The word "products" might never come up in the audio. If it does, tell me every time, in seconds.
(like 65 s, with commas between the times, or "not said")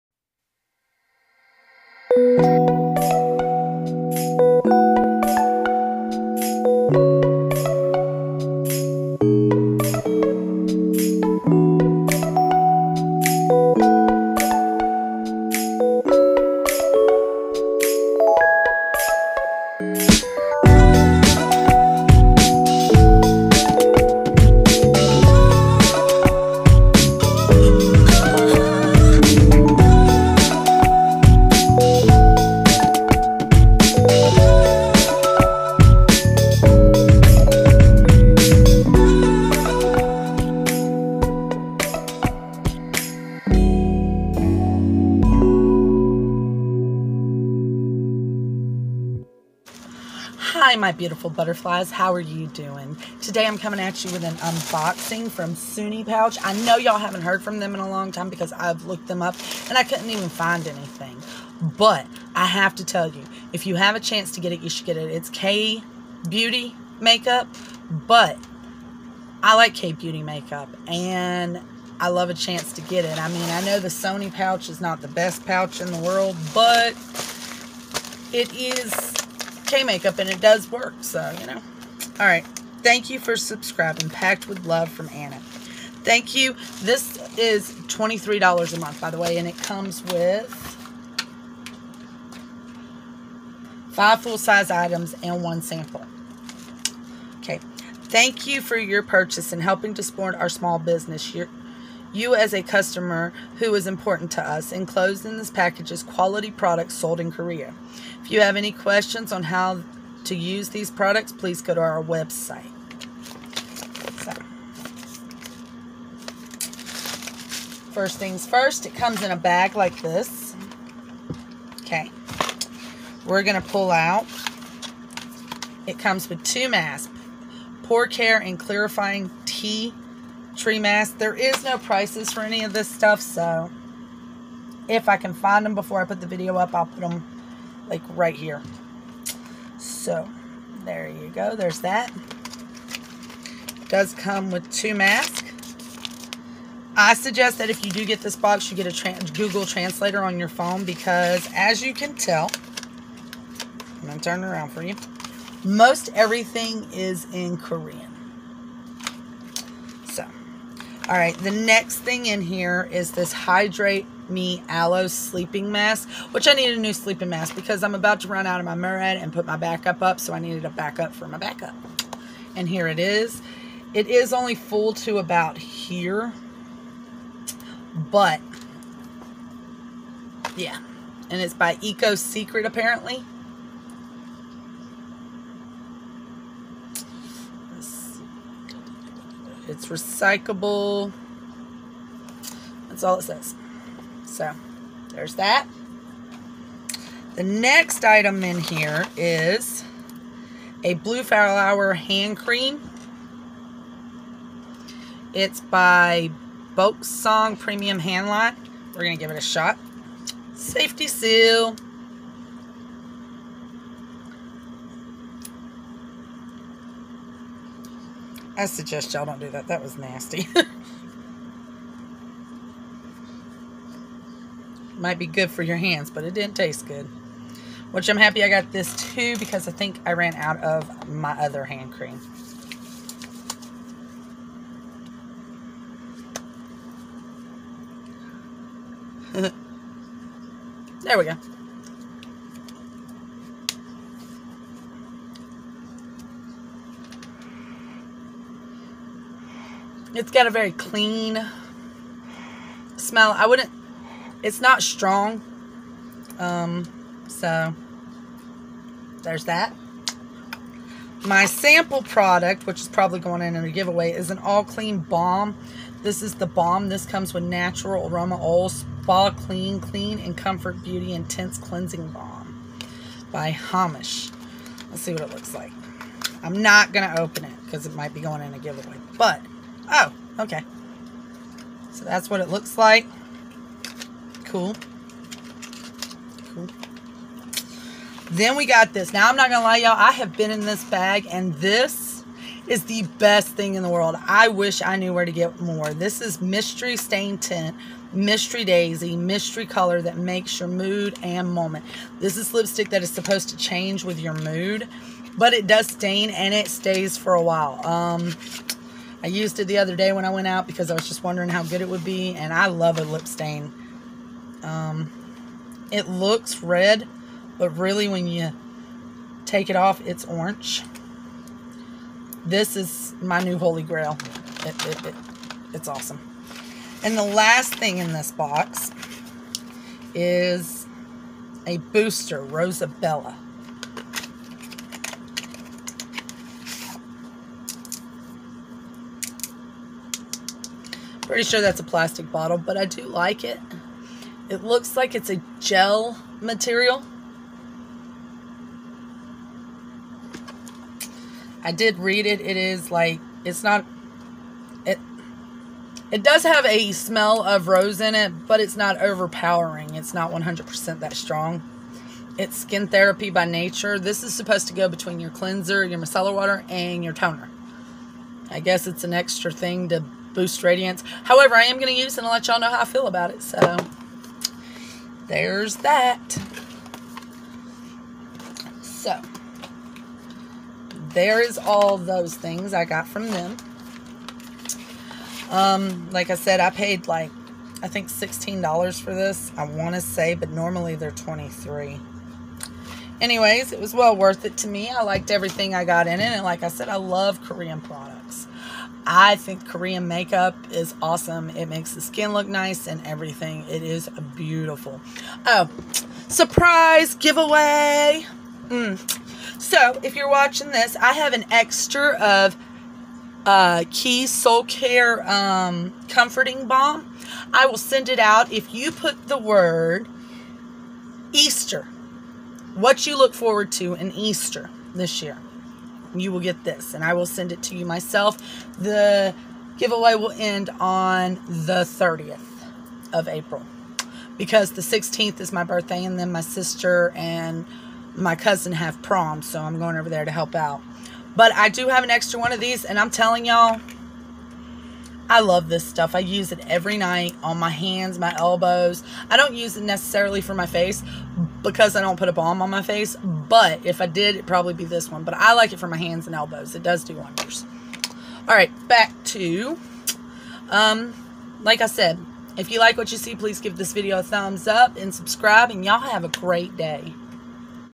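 106 s, 110 s, 262 s, 397 s.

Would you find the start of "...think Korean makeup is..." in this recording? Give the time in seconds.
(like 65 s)
399 s.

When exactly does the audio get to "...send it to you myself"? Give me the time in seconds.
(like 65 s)
427 s.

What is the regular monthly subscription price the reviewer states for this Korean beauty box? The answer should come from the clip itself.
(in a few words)
$23.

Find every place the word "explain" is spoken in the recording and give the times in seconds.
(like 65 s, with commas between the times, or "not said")
not said.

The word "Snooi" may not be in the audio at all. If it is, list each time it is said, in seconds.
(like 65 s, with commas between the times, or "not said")
55 s, 73 s.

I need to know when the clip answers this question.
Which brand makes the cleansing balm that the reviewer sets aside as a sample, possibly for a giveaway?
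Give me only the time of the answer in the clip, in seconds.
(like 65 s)
273 s.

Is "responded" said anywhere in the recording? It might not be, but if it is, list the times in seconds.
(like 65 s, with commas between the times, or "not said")
not said.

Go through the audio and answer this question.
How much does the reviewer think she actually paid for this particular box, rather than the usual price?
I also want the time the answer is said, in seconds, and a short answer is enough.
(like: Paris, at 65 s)
$16, at 388 s.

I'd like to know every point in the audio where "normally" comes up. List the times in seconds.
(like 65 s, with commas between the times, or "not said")
390 s.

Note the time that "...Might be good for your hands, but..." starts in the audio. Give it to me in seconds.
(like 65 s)
224 s.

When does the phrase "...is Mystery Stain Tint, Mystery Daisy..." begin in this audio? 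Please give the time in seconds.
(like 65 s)
296 s.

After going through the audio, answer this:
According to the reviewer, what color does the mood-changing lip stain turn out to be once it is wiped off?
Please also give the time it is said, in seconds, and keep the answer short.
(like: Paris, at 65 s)
Orange, at 320 s.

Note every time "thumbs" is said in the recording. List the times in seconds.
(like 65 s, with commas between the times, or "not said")
464 s.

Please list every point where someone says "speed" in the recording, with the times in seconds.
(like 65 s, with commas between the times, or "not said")
not said.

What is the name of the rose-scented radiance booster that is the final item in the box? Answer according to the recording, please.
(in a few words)
Rosabella.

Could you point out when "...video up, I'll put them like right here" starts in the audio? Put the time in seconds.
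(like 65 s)
136 s.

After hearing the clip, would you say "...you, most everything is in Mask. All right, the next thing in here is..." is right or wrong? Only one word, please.
wrong.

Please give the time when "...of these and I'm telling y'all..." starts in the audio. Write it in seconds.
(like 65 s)
442 s.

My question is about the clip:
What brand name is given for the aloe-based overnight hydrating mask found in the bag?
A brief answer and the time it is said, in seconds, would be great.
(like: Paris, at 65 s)
Eco Secret, at 181 s.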